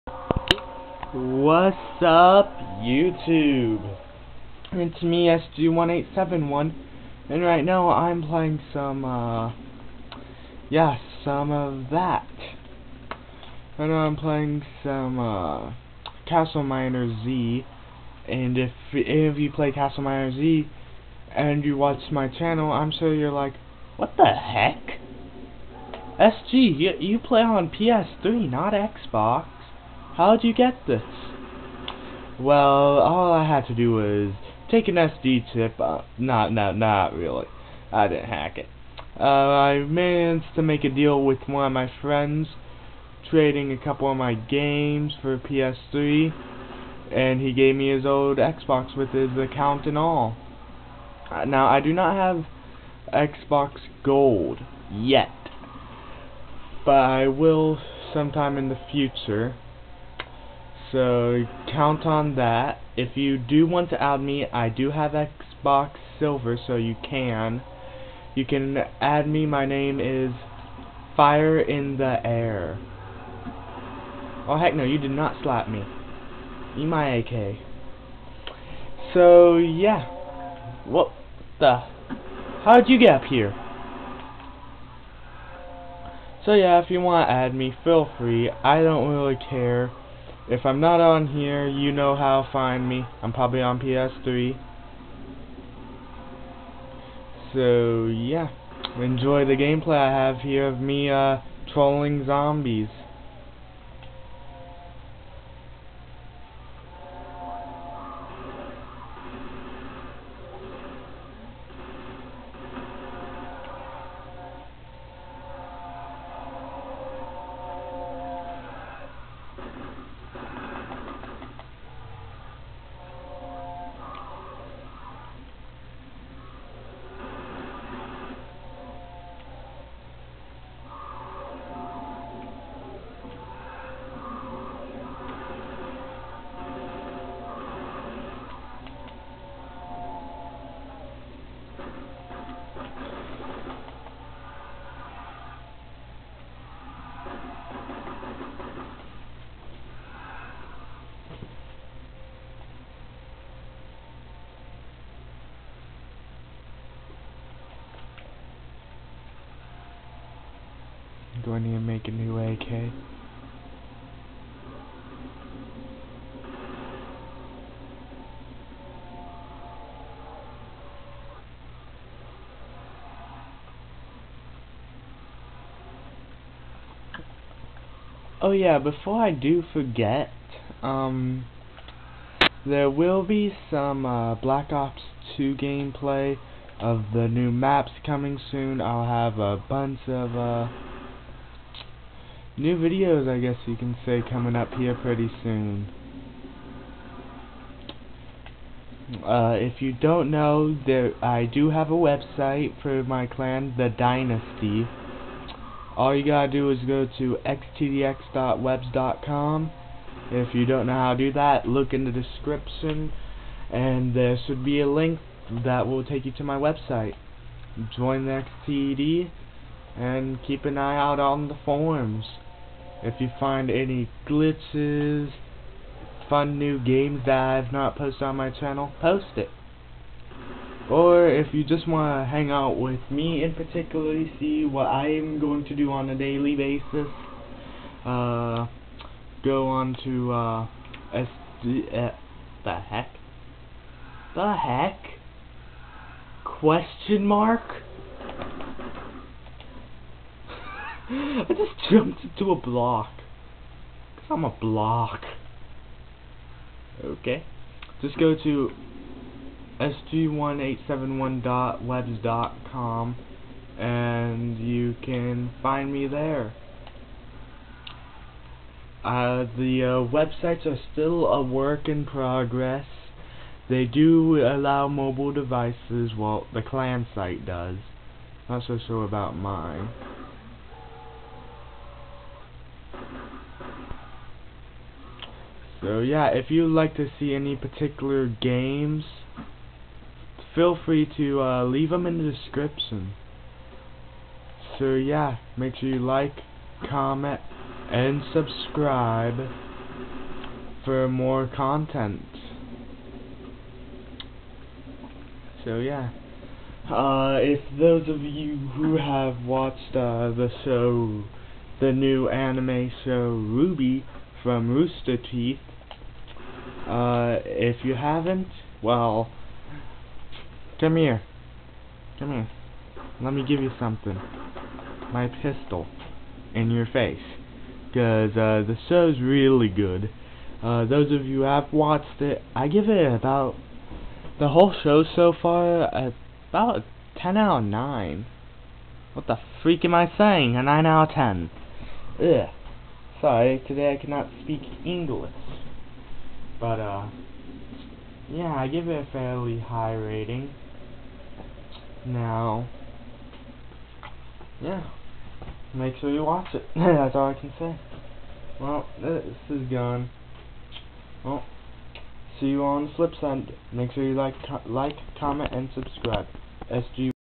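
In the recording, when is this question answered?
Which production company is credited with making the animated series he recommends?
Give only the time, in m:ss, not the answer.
5:14.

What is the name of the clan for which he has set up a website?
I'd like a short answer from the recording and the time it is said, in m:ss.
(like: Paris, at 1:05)
The Dynasty, at 3:23.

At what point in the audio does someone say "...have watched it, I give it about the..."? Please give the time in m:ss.
5:31.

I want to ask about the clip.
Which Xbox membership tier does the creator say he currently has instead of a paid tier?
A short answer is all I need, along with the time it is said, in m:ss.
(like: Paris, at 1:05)
Xbox Silver, at 1:05.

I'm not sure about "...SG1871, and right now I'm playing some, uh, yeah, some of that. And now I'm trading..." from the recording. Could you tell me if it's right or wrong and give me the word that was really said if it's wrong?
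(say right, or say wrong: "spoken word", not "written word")
wrong: "playing", not "trading".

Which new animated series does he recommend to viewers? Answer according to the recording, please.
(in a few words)
RWBY.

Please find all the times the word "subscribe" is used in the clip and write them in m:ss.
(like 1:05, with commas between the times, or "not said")
4:58, 6:05.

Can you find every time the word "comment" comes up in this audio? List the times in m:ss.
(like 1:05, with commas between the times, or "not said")
4:56, 6:05.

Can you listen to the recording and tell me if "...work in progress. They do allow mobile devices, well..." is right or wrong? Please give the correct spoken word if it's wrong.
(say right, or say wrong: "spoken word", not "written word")
right.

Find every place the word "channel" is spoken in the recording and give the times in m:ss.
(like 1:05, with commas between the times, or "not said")
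0:22, 3:48.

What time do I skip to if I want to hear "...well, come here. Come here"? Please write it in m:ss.
5:18.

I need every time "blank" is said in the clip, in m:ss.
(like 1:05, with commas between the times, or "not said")
not said.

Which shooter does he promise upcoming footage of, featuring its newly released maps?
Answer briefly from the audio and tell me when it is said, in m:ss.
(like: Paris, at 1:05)
Black Ops 2, at 3:04.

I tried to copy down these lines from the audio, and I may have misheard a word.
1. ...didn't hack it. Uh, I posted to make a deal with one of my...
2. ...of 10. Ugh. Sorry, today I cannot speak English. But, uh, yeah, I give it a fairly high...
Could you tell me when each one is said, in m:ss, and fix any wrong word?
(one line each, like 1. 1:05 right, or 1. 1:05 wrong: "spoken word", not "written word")
1. 0:38 wrong: "managed", not "posted"
2. 5:41 right.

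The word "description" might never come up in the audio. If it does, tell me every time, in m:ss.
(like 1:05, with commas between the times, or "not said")
3:32, 4:52.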